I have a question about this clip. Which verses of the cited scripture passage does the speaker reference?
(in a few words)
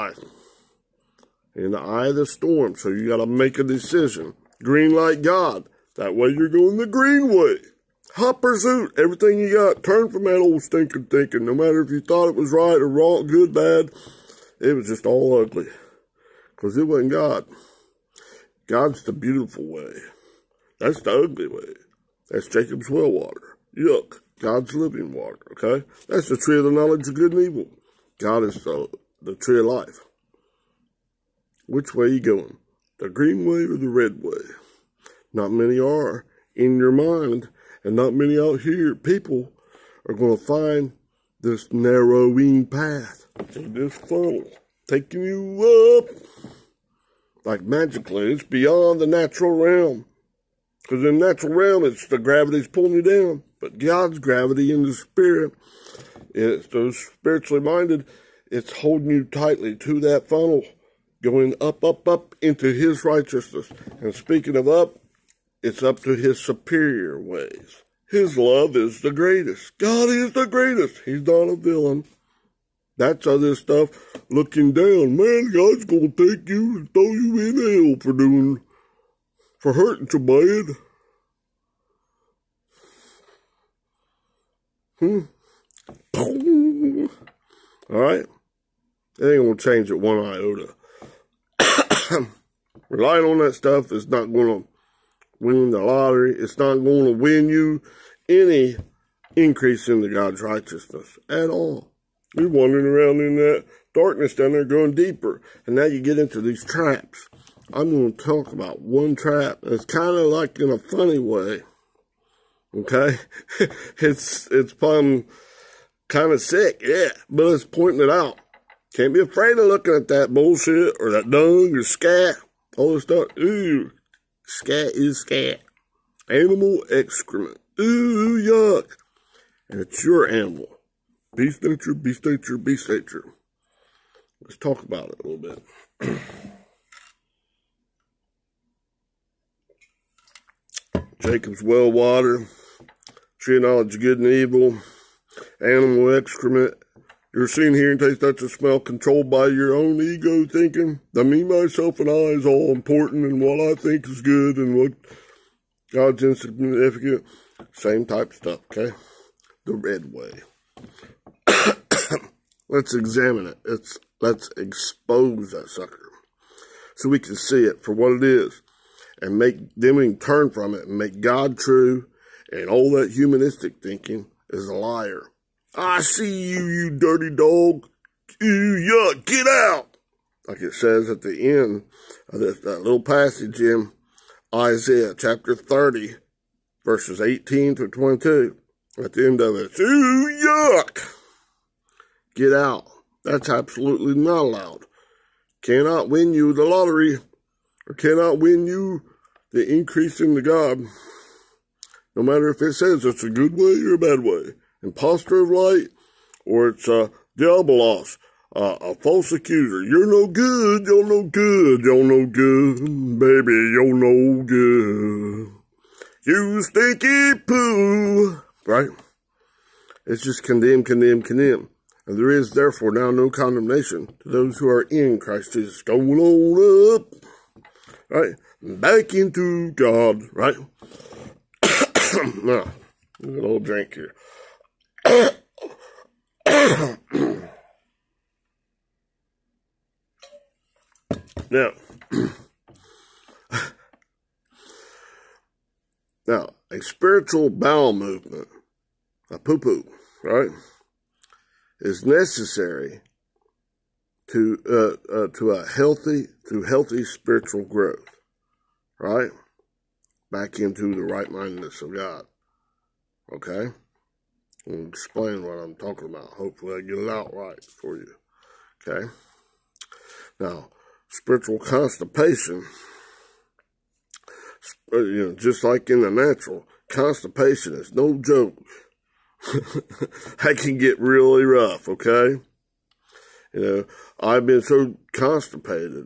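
18 to 22.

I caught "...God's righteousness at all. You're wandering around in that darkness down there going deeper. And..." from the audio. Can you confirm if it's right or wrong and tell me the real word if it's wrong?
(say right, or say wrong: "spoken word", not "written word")
right.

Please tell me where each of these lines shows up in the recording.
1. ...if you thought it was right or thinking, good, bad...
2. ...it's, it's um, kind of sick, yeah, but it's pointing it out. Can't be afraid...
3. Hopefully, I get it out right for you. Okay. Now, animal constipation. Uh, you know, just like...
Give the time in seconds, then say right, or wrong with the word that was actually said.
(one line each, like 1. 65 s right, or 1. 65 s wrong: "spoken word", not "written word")
1. 11 s wrong: "wrong", not "thinking"
2. 113 s right
3. 266 s wrong: "spiritual", not "animal".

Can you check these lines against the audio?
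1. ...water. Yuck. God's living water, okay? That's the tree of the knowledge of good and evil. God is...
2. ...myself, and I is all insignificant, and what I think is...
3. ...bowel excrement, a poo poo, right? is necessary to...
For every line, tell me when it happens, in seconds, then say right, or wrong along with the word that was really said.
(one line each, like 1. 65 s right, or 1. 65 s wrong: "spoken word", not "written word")
1. 23 s right
2. 151 s wrong: "important", not "insignificant"
3. 247 s wrong: "movement", not "excrement".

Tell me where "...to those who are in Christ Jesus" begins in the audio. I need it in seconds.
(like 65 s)
224 s.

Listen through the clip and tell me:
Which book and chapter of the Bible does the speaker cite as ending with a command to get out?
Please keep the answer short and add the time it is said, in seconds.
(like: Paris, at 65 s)
Isaiah chapter 30, at 184 s.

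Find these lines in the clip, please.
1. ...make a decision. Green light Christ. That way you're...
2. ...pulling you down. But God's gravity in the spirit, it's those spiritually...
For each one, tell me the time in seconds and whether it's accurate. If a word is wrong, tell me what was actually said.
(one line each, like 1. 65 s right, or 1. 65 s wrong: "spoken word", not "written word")
1. 3 s wrong: "God", not "Christ"
2. 52 s right.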